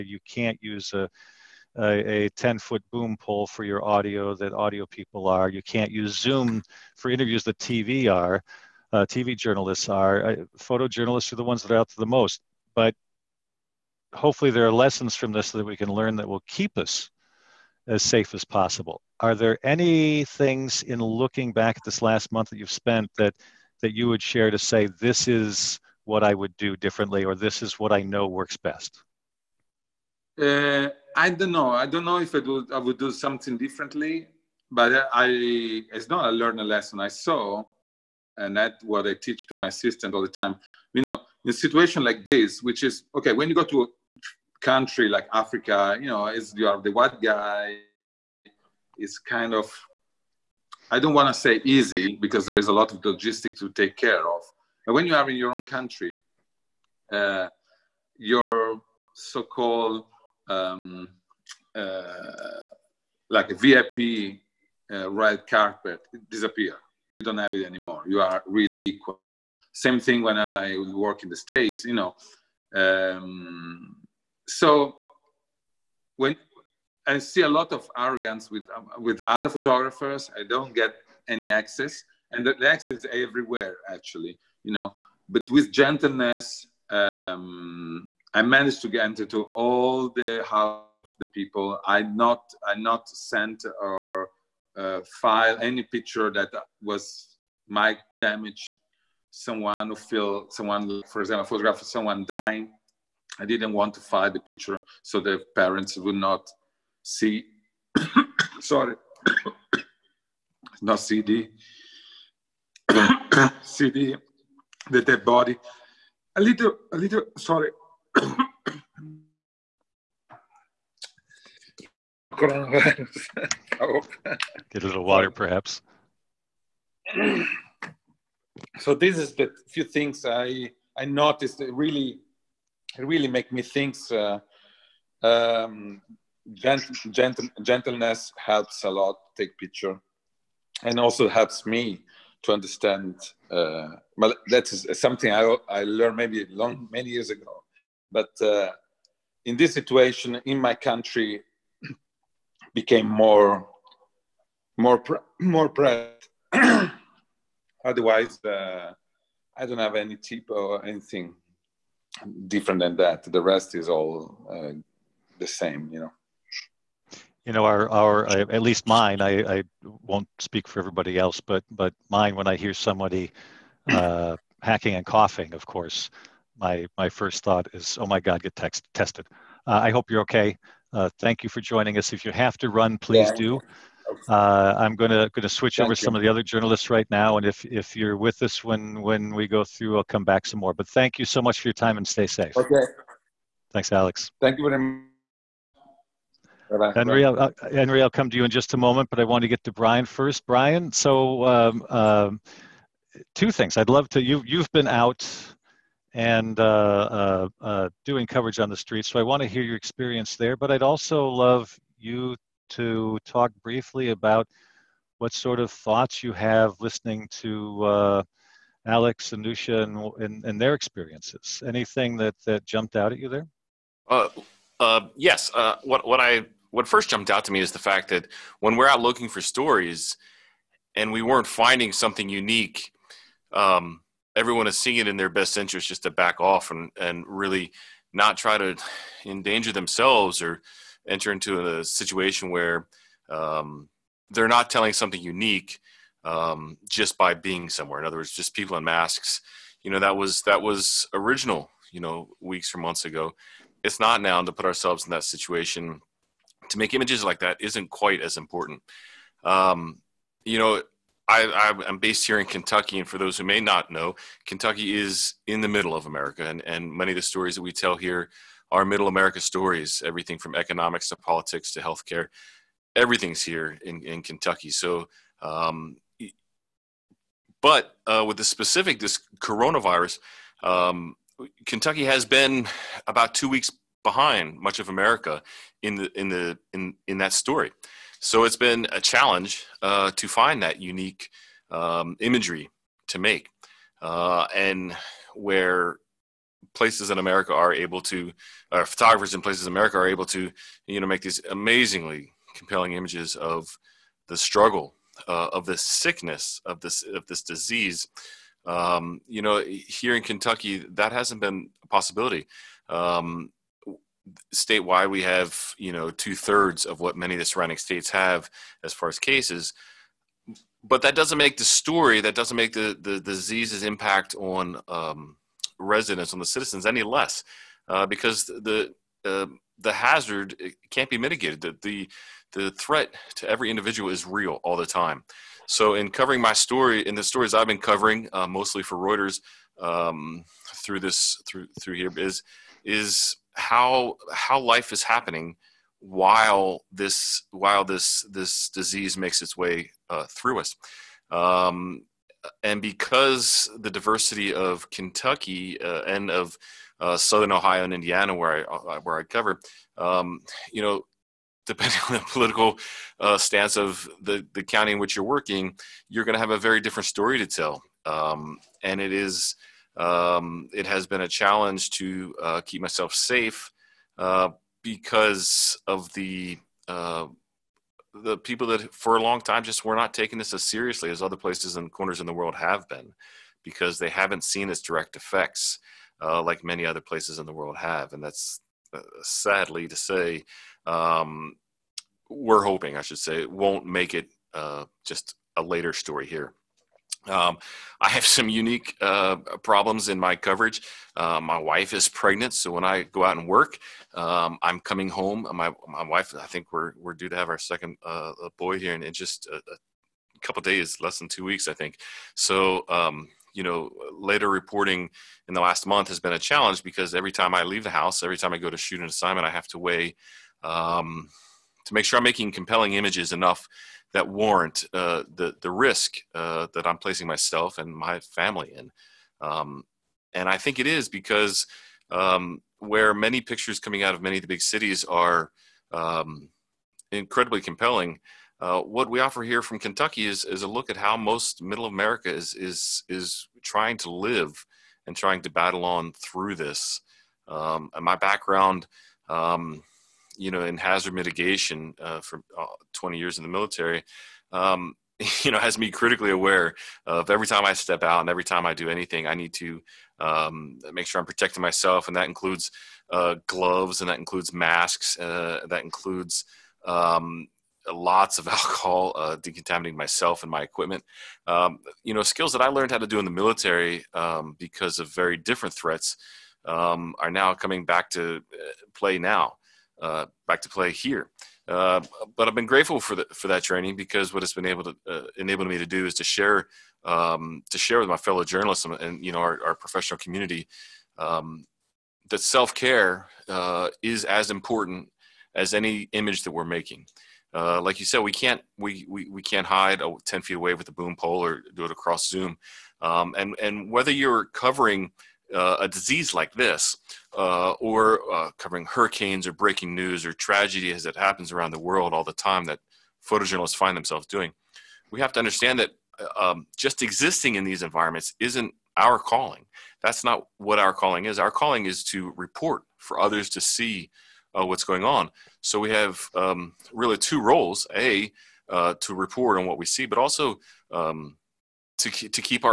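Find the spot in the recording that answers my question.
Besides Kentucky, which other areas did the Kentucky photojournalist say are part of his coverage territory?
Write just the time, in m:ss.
5:57.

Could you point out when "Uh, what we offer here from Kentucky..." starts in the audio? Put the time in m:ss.
7:18.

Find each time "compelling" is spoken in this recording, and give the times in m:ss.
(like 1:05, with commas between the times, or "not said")
5:02, 7:02, 7:17.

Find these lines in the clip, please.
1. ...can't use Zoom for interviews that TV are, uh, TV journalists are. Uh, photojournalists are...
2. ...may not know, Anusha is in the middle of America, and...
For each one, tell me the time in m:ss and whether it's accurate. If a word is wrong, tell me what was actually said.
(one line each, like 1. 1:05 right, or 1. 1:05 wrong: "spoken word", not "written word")
1. 0:05 right
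2. 4:23 wrong: "Kentucky", not "Anusha".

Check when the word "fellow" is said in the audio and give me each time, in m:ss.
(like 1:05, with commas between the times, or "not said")
8:08.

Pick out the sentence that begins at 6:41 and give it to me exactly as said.
Uh, my wife is pregnant, so when I go out and work, um, I'm coming home.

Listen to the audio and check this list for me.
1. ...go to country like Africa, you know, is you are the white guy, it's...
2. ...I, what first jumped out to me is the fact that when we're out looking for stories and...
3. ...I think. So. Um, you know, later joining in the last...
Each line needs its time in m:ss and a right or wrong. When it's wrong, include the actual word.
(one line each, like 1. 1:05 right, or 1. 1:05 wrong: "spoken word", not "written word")
1. 0:43 right
2. 3:46 right
3. 6:51 wrong: "reporting", not "joining".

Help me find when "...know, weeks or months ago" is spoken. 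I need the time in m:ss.
4:11.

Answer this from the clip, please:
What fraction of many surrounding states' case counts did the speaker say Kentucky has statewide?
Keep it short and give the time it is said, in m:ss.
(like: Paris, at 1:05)
Two thirds, at 5:16.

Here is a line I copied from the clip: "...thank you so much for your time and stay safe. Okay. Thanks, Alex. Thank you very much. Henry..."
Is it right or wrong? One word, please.
right.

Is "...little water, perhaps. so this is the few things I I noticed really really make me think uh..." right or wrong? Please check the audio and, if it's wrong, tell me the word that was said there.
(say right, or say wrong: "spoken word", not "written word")
right.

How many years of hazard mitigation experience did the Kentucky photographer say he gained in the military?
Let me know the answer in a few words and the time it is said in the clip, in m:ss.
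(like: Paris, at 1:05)
20, at 7:32.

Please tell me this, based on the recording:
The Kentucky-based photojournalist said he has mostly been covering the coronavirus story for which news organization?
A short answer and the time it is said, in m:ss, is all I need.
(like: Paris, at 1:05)
Reuters, at 5:38.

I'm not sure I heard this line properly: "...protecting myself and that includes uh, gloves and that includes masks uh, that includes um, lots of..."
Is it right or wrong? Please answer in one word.
right.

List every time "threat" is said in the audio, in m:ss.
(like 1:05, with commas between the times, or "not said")
5:32, 7:55.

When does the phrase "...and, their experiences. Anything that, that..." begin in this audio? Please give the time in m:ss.
3:40.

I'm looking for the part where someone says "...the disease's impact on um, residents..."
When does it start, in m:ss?
5:23.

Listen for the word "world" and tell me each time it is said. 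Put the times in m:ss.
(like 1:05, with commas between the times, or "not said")
6:22, 6:27, 8:31.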